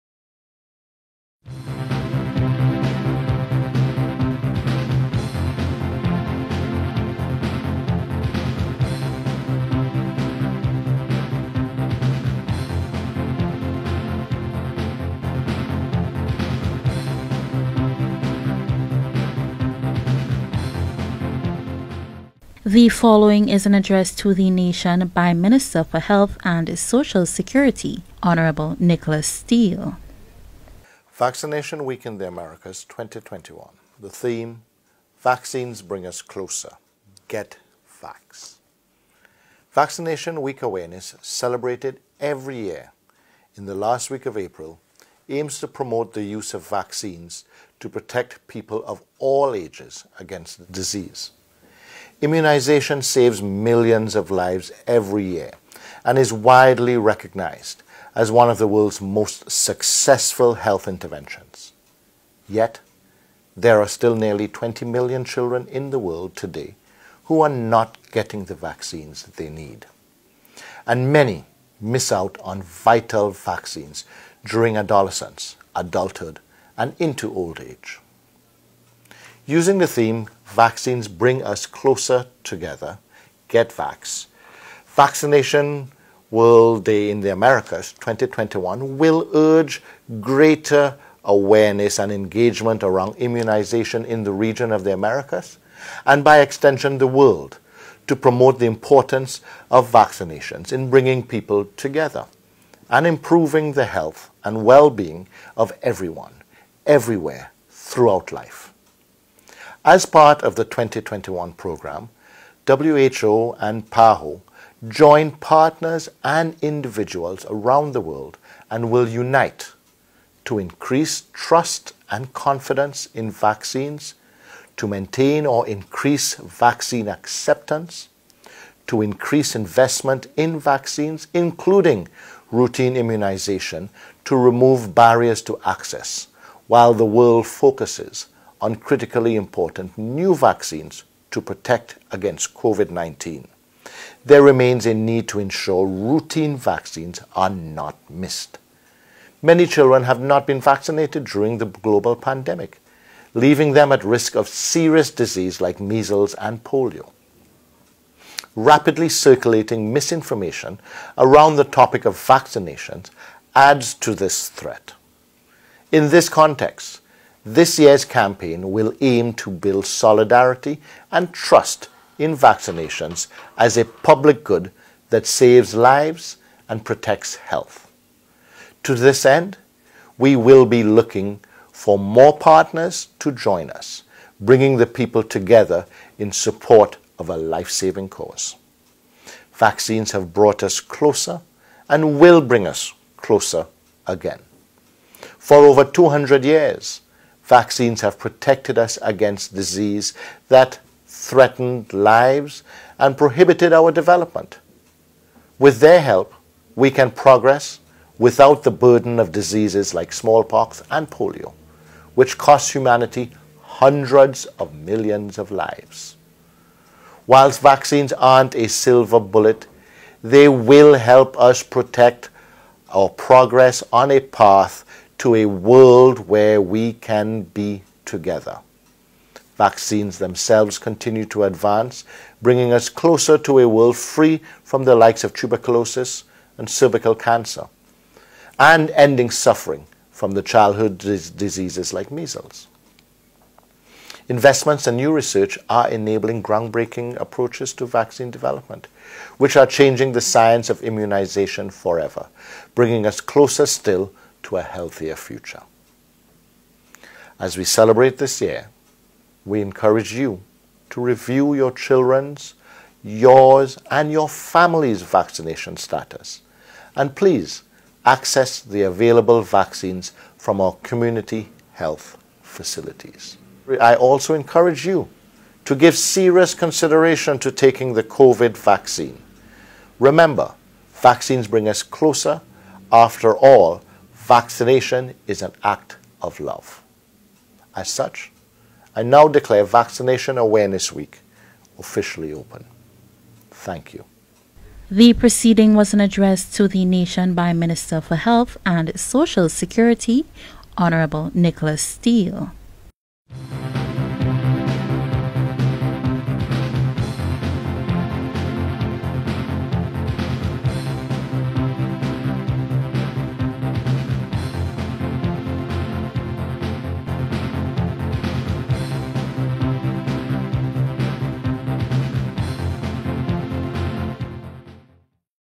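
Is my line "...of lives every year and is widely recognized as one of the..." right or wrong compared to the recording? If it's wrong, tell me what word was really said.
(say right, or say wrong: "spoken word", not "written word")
right.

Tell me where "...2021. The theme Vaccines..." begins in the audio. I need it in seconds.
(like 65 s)
32 s.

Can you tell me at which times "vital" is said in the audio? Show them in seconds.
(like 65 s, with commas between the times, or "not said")
72 s.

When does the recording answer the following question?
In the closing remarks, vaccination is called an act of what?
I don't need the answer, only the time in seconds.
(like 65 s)
286 s.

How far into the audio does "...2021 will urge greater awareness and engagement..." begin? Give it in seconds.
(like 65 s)
87 s.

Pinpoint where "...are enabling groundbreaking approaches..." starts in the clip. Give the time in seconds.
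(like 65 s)
245 s.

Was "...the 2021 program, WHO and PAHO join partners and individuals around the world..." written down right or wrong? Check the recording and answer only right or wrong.
right.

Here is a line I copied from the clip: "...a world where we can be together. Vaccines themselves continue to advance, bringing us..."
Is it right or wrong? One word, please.
right.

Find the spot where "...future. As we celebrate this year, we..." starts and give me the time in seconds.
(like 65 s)
255 s.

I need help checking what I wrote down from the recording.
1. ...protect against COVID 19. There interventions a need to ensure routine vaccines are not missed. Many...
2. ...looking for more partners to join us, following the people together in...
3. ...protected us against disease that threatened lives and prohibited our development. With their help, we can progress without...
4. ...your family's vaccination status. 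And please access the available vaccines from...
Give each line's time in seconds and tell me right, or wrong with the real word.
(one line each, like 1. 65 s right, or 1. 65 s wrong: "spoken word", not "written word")
1. 141 s wrong: "remains", not "interventions"
2. 180 s wrong: "bringing", not "following"
3. 198 s right
4. 264 s right.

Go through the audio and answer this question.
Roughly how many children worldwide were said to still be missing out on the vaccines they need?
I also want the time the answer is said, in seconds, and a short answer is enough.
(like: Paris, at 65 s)
20 million, at 64 s.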